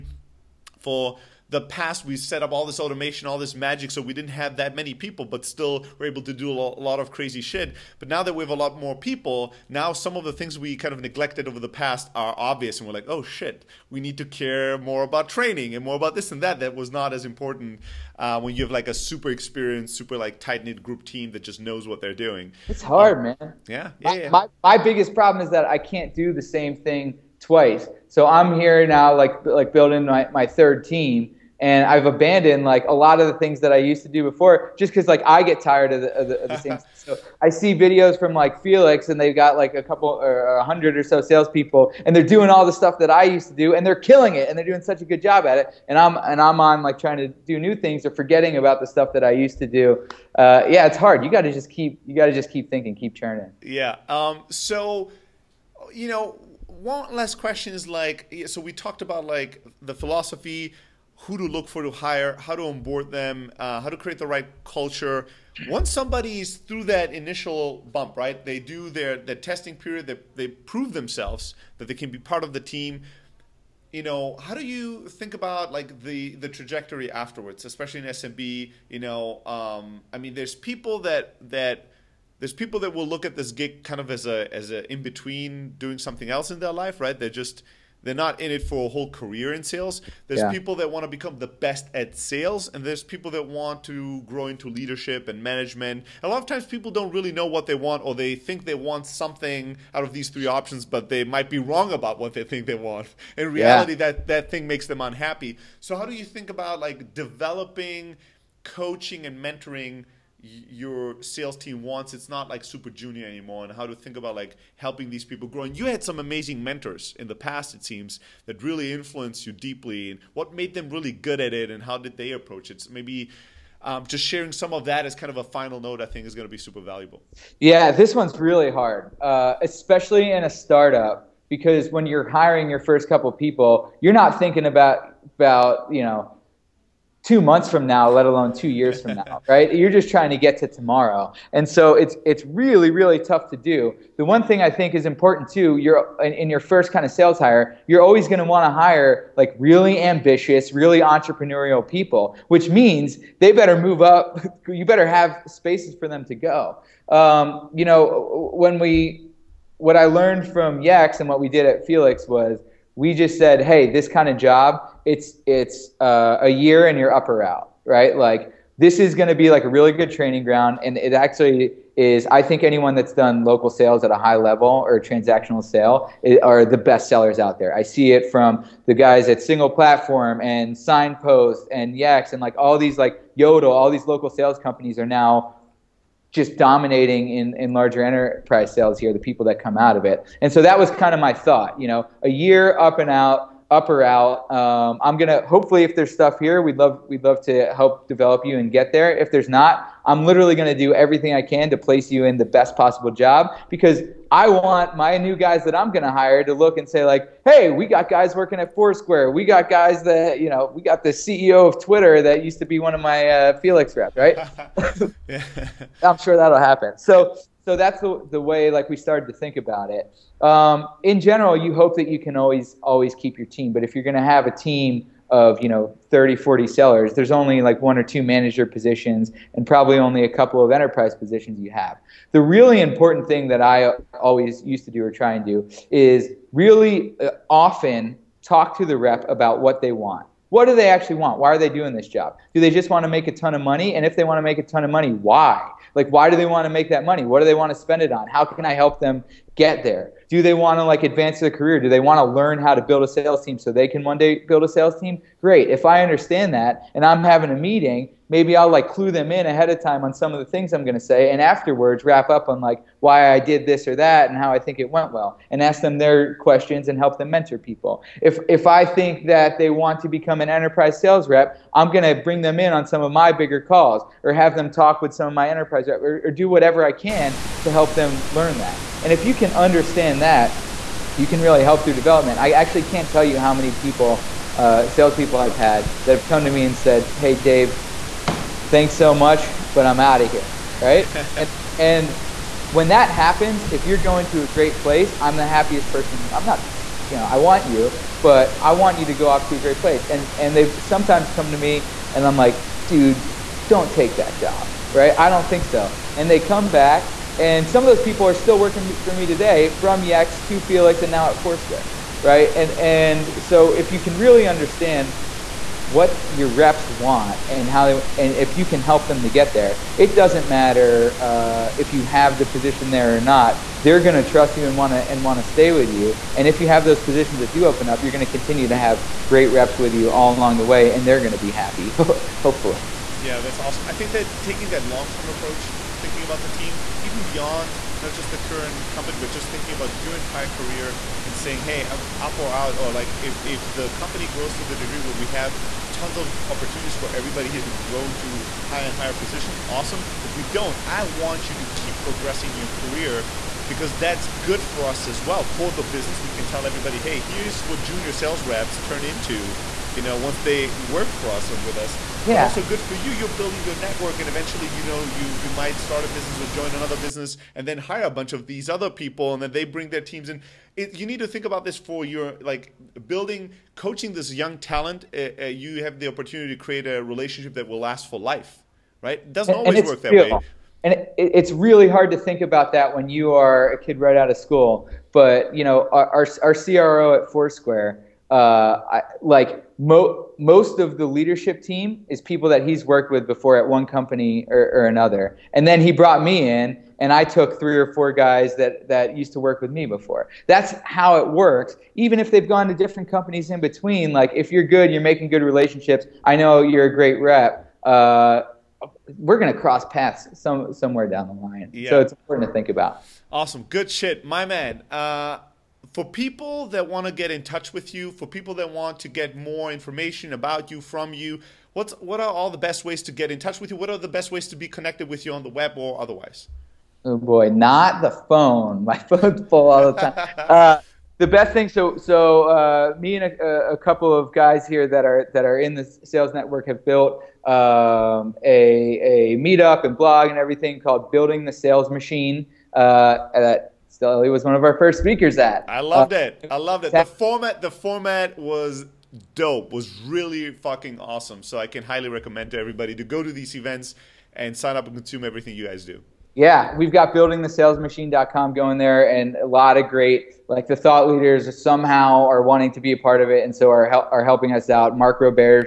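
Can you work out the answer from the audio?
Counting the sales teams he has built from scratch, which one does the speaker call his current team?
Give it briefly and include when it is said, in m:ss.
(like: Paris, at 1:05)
third, at 0:30.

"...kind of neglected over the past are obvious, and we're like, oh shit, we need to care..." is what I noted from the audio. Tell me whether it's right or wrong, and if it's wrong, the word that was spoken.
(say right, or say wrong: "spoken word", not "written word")
right.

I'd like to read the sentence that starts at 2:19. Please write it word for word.
You're just trying to get to tomorrow.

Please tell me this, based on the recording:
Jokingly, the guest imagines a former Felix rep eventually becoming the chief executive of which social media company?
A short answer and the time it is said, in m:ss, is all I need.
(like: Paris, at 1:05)
Twitter, at 3:31.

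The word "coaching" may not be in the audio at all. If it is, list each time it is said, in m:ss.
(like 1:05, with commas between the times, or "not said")
1:48, 6:13.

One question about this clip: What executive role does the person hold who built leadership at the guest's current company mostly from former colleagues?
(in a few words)
CRO.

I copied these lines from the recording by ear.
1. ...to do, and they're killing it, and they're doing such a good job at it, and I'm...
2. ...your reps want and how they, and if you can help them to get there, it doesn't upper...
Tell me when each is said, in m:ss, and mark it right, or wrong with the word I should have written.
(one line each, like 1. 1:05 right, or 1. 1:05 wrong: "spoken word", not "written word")
1. 0:43 right
2. 5:16 wrong: "matter", not "upper".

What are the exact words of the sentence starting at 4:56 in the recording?
I'm not, you know, I want you, but I want you to go off to a great place.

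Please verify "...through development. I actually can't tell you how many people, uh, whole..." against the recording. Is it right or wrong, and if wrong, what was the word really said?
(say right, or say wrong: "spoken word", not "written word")
wrong: "salespeople", not "whole".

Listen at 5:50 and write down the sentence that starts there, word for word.
If we don't, I want you to keep progressing your career because that's good for us as well.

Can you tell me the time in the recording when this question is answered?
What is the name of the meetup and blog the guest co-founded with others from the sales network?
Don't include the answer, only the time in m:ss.
7:21.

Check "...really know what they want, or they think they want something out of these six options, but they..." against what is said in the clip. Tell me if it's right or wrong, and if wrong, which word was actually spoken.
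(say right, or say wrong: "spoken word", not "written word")
wrong: "three", not "six".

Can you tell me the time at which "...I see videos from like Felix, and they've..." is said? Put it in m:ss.
0:37.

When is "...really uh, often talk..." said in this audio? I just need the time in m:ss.
3:56.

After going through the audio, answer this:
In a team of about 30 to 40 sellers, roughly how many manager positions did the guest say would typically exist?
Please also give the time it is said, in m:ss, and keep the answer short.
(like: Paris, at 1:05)
one or two, at 3:47.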